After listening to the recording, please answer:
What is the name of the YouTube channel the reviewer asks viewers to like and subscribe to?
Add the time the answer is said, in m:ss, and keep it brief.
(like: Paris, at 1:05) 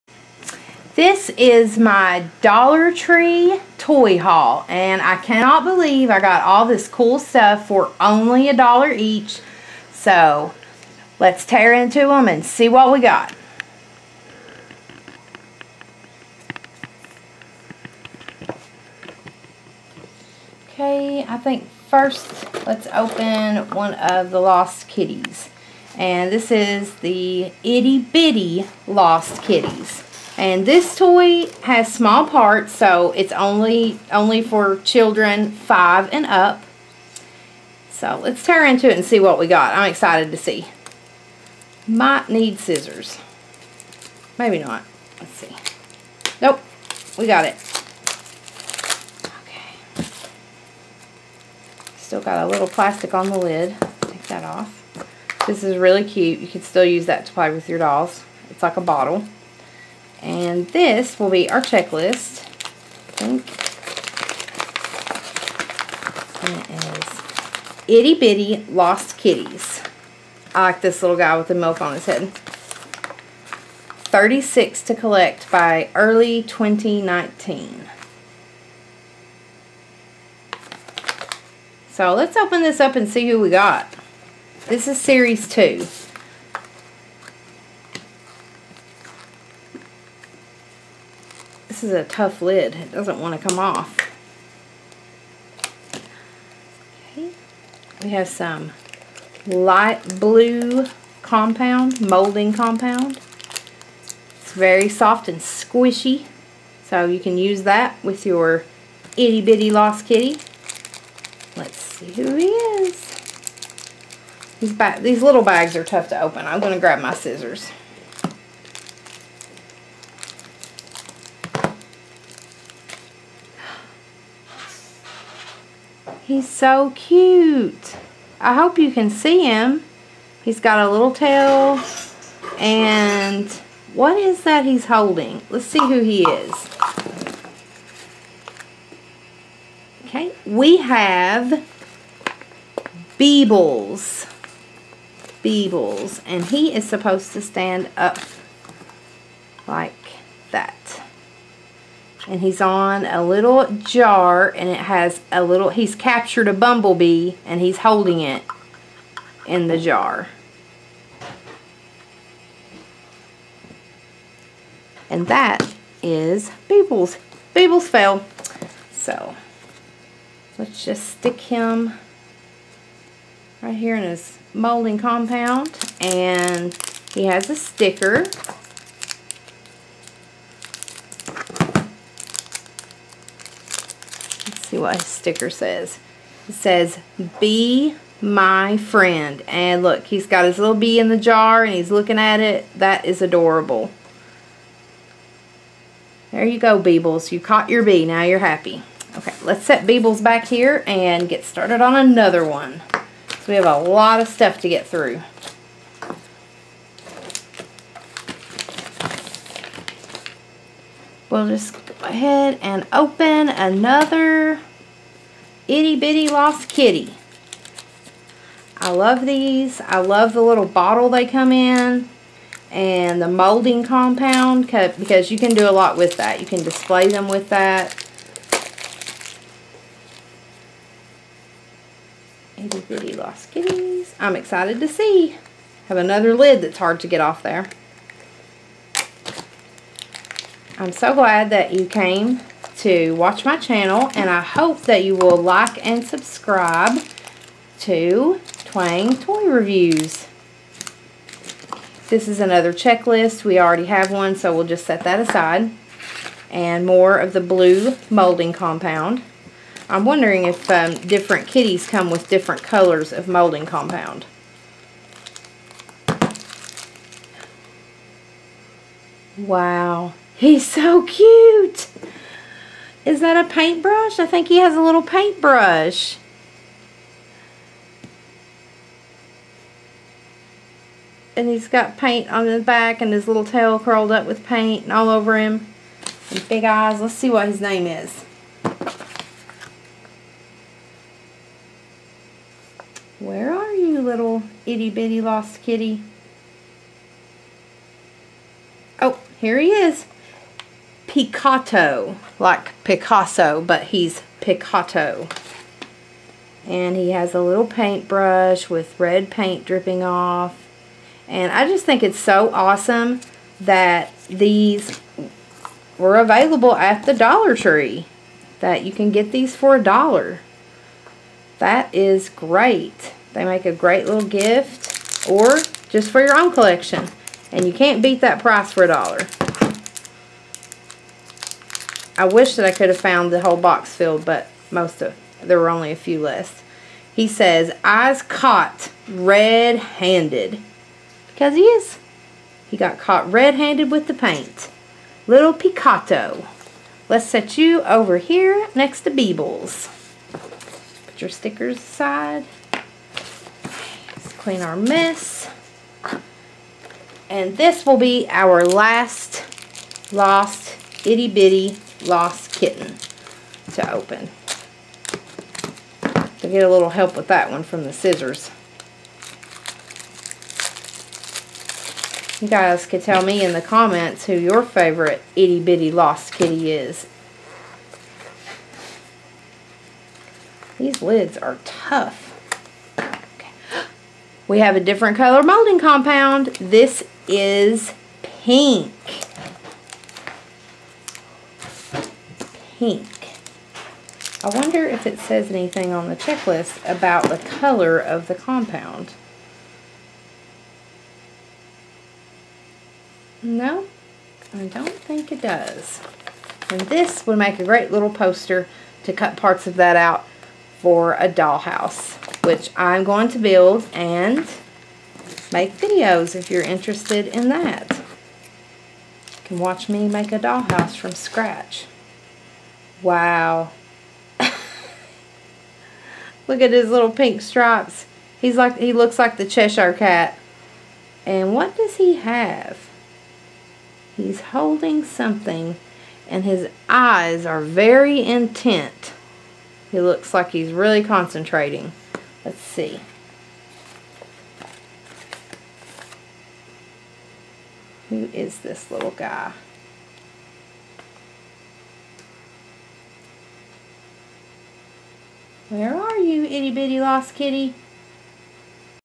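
Twang Toy Reviews, at 4:08.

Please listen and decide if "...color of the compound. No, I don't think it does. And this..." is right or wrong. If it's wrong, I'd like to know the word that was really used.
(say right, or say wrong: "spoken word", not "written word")
right.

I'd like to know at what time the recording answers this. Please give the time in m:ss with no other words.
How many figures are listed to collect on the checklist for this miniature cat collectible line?
1:14.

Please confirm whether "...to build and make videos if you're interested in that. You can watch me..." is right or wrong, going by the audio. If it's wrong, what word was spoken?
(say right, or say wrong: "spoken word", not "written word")
right.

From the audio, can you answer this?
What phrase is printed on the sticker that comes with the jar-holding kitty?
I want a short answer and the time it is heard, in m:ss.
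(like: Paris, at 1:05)
Be my friend, at 3:07.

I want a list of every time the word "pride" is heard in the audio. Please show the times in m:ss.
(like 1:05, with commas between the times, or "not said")
not said.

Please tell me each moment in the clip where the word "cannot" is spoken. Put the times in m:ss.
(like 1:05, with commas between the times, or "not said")
0:05.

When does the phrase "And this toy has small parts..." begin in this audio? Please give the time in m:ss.
0:30.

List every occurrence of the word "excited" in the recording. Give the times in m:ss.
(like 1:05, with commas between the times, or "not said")
0:39, 3:54.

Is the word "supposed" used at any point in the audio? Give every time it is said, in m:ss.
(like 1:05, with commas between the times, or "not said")
2:26.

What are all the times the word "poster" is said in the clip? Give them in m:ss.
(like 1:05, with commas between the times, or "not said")
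6:48.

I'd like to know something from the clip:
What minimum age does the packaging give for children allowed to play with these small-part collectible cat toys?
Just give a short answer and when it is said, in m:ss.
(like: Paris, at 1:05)
5 and up, at 0:35.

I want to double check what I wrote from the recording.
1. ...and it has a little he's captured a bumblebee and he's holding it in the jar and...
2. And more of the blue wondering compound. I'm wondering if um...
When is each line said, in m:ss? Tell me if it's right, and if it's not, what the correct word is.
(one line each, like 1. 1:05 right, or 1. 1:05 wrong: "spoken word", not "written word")
1. 2:34 right
2. 4:16 wrong: "molding", not "wondering".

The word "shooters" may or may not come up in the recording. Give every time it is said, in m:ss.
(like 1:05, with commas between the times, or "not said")
not said.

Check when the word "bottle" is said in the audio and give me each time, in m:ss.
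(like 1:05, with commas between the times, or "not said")
0:58, 3:40.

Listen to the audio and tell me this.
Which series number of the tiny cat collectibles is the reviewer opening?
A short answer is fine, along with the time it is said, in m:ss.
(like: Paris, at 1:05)
Series two, at 1:24.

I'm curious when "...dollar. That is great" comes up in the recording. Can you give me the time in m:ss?
5:19.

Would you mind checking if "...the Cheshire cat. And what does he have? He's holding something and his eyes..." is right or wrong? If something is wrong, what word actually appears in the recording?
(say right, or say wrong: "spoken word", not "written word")
right.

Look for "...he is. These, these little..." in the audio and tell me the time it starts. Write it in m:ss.
1:52.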